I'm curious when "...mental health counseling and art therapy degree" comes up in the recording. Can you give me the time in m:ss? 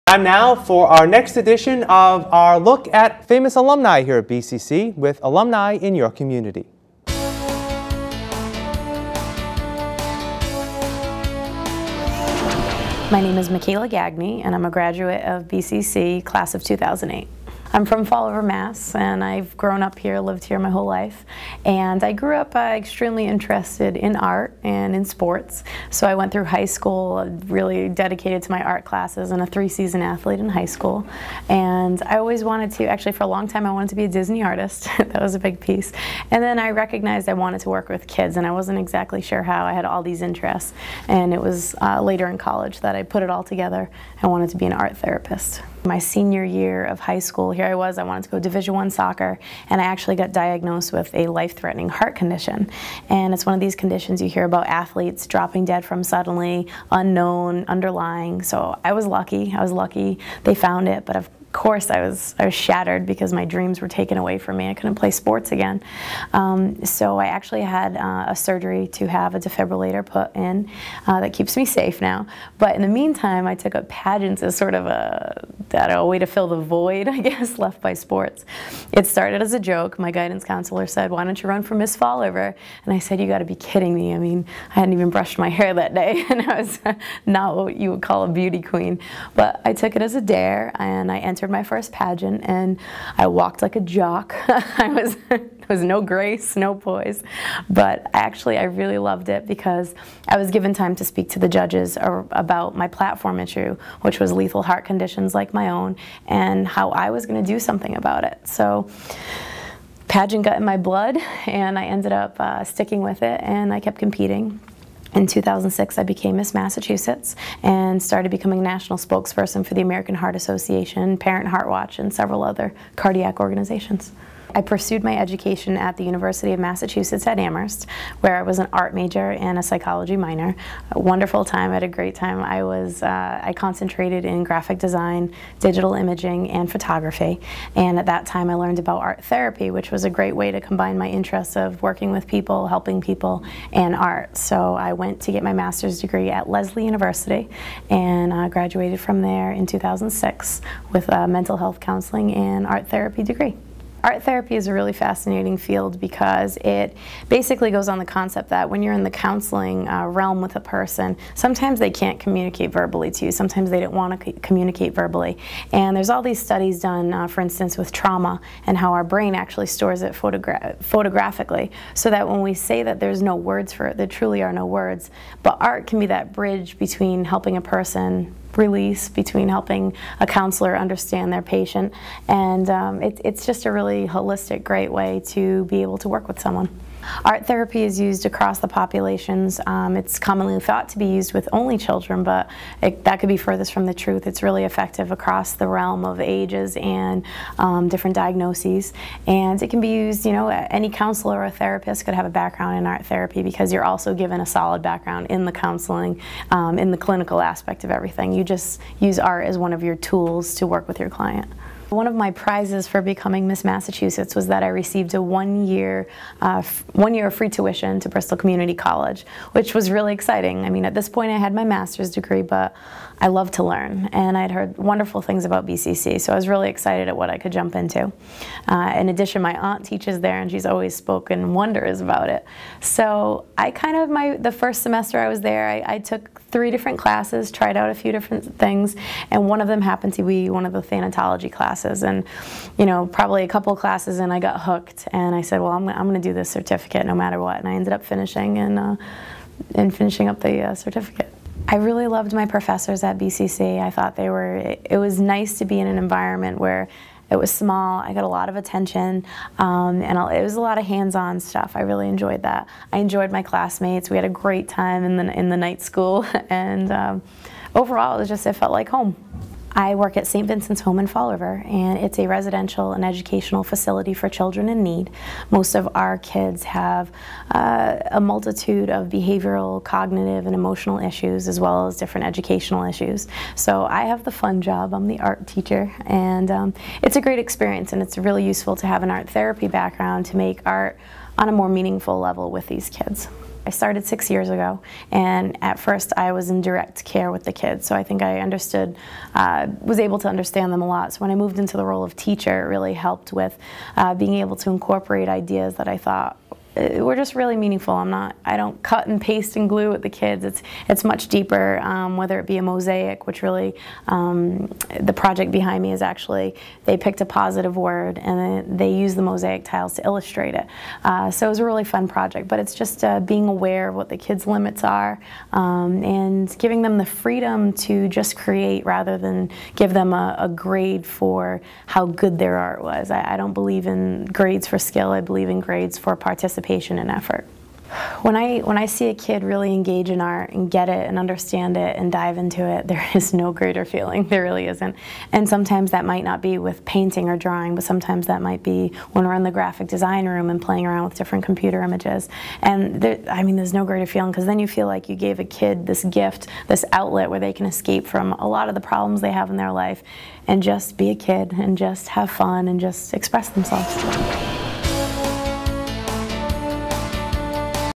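2:31.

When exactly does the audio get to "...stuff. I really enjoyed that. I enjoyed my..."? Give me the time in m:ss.
4:21.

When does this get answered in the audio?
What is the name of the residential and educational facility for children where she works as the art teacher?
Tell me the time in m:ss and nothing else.
4:30.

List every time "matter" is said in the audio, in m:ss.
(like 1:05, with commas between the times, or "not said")
4:07.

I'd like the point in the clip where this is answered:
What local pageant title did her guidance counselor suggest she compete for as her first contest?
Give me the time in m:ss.
1:21.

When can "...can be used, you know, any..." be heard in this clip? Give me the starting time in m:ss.
3:19.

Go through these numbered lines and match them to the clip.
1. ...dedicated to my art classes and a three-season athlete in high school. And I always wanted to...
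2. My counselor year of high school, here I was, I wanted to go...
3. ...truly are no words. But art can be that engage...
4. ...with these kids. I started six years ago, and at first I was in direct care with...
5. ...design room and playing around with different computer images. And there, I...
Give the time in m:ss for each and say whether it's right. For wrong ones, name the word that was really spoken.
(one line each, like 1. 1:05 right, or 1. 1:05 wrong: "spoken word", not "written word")
1. 0:27 right
2. 0:45 wrong: "senior", not "counselor"
3. 2:54 wrong: "bridge", not "engage"
4. 4:52 right
5. 5:49 right.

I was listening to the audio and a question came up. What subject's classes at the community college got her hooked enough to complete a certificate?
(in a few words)
Thanatology.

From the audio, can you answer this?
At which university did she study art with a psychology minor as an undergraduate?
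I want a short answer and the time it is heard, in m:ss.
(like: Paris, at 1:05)
University of Massachusetts at Amherst, at 2:06.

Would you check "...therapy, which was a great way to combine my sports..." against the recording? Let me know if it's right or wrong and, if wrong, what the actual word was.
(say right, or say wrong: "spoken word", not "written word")
wrong: "interests", not "sports".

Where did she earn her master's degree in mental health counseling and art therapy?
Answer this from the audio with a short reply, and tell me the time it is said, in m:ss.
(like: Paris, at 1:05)
Lesley University, at 2:26.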